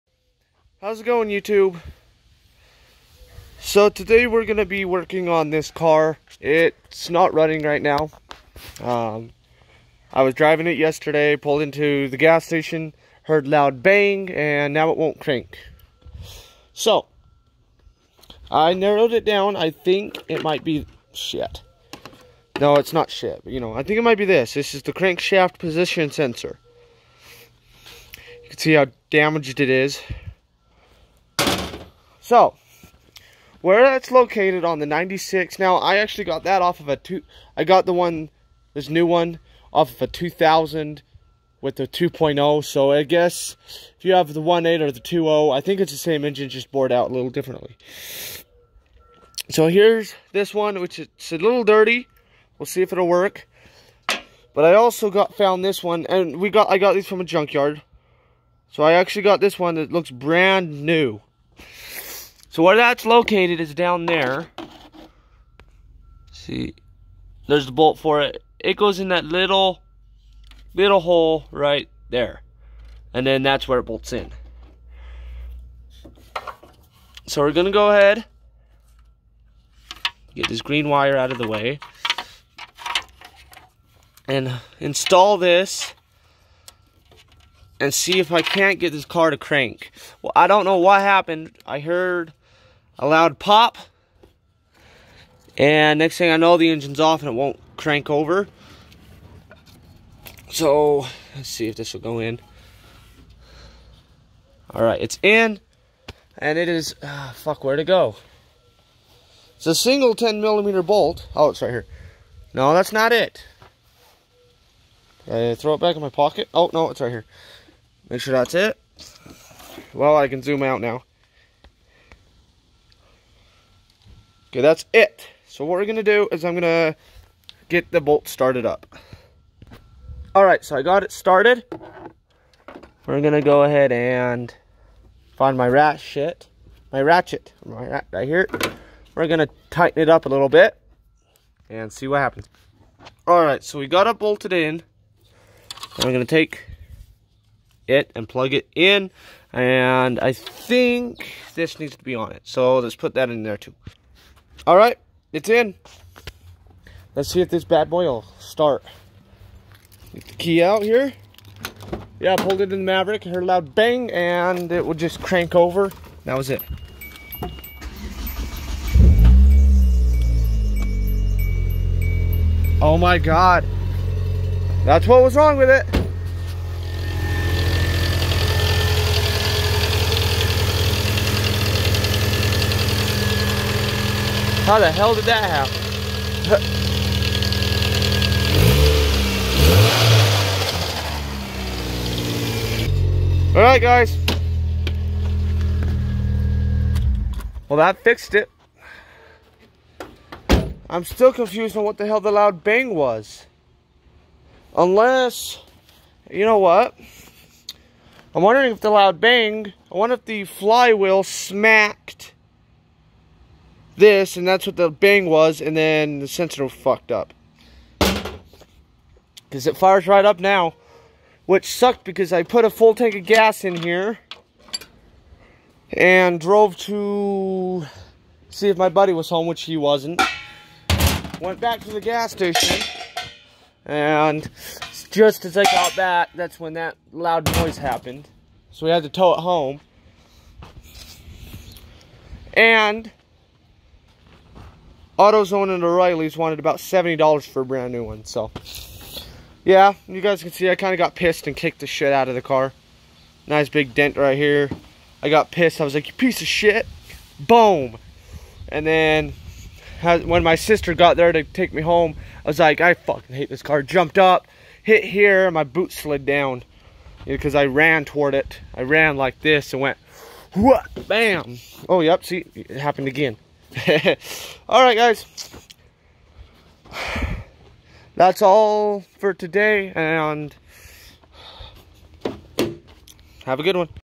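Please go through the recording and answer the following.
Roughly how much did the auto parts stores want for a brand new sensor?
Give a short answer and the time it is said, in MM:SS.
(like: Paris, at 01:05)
$70, at 04:06.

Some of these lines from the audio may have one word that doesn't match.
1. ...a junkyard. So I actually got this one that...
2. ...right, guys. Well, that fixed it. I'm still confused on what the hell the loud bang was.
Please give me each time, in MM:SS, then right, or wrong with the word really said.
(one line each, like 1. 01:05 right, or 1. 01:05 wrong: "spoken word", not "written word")
1. 00:57 right
2. 03:13 right.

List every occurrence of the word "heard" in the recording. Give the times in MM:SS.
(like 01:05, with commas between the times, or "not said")
00:13, 01:31, 02:43.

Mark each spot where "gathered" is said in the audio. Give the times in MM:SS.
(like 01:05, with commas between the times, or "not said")
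not said.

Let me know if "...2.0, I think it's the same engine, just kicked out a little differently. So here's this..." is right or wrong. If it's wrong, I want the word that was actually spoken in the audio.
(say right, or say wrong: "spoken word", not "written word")
wrong: "bored", not "kicked".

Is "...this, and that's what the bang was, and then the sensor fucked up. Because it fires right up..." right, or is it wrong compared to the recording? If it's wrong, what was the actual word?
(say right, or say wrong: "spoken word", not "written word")
right.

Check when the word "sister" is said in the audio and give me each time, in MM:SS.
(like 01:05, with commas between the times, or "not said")
04:20.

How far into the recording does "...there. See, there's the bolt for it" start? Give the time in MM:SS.
01:04.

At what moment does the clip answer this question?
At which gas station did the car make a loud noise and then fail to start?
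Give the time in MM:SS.
02:42.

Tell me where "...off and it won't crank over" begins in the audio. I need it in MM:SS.
01:36.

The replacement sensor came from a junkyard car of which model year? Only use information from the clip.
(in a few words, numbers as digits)
2000.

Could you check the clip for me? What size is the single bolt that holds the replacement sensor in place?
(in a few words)
10 millimeter.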